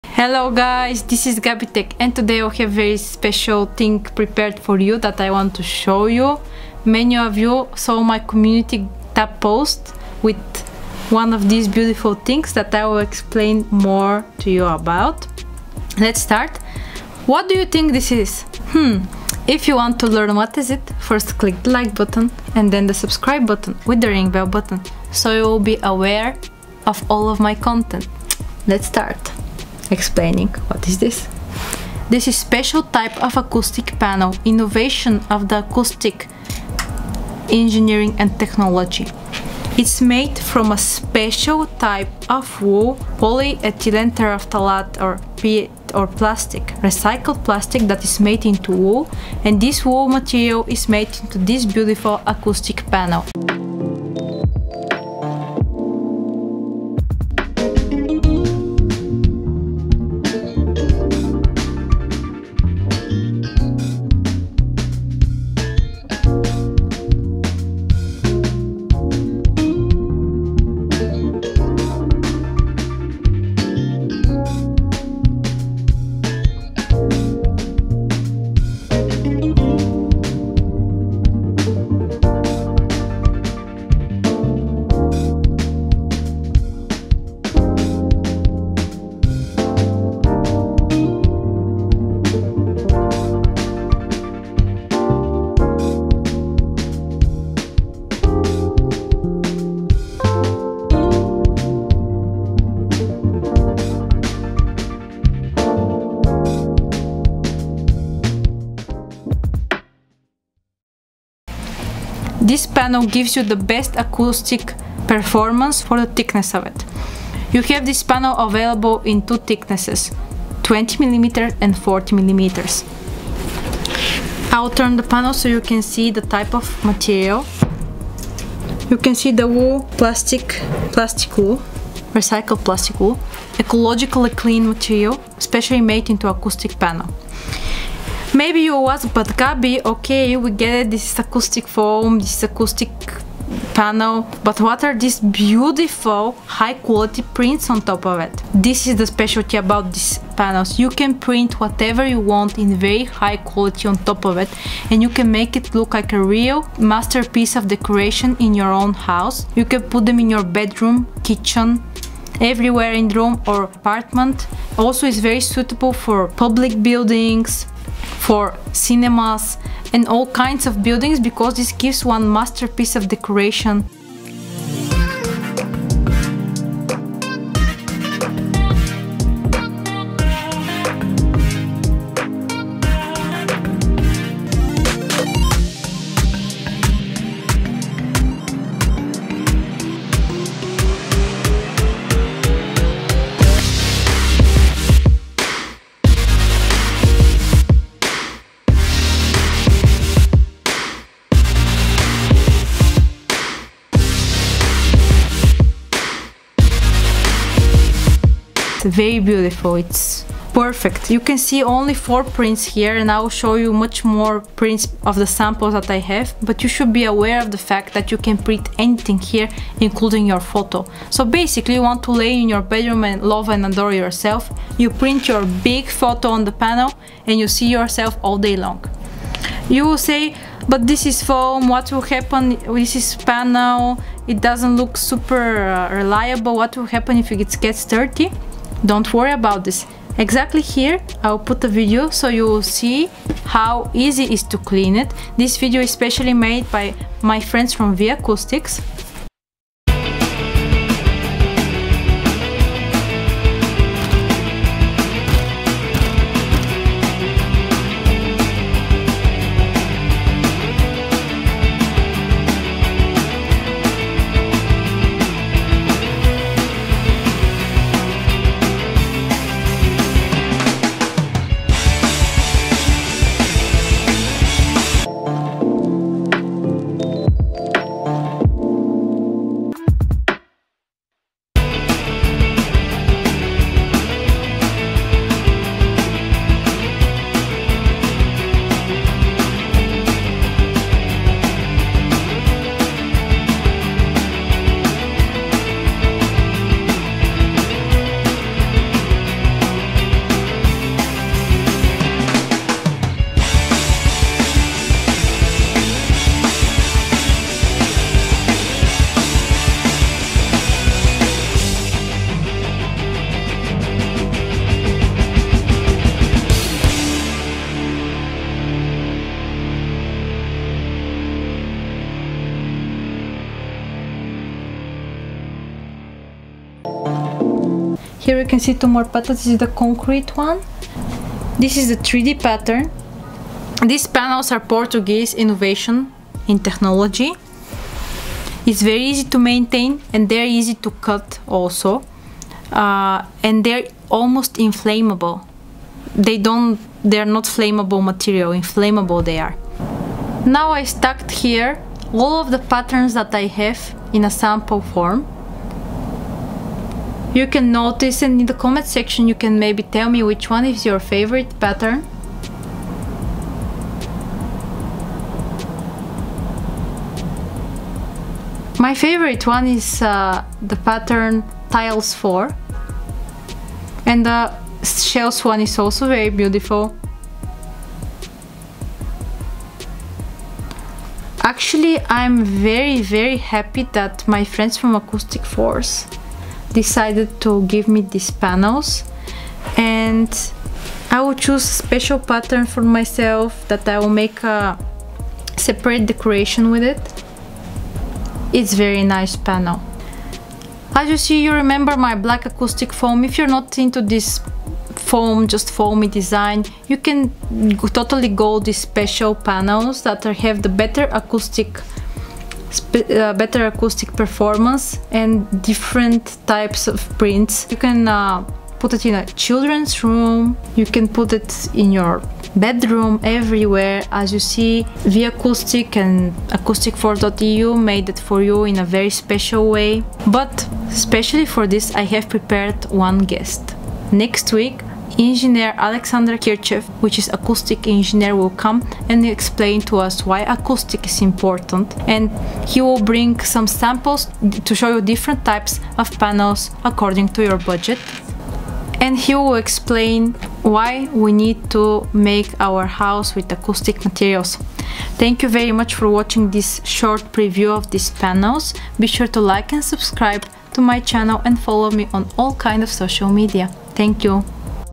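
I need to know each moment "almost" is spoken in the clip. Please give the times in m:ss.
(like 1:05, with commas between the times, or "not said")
5:44.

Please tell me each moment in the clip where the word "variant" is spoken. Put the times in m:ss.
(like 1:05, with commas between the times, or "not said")
not said.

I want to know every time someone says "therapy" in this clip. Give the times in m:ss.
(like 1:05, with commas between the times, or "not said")
not said.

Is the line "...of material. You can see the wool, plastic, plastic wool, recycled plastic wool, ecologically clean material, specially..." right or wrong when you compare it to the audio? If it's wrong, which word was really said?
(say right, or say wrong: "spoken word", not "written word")
right.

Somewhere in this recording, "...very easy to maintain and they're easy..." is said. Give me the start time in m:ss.
5:38.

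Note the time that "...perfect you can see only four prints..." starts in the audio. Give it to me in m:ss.
3:30.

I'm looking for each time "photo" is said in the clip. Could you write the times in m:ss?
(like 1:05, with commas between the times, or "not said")
3:40, 3:45.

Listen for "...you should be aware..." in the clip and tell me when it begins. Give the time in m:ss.
3:36.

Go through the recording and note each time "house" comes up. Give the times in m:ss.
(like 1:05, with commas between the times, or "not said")
2:38, 7:32.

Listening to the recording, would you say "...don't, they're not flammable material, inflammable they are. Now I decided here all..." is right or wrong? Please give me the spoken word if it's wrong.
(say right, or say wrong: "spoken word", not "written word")
wrong: "stacked", not "decided".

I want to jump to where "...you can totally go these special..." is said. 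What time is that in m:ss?
6:46.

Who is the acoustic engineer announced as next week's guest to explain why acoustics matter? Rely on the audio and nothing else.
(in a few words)
Alexander Kirchev.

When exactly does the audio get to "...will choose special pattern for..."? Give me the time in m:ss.
6:31.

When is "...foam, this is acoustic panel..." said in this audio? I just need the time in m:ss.
2:21.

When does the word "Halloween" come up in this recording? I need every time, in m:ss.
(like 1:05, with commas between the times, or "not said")
not said.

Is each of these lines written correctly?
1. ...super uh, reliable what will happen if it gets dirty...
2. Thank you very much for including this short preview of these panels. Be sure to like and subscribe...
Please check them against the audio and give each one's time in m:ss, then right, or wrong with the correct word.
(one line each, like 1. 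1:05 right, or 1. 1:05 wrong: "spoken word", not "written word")
1. 3:54 right
2. 7:35 wrong: "watching", not "including".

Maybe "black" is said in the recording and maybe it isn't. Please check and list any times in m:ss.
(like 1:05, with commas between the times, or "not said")
6:42.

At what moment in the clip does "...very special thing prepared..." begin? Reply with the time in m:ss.
0:02.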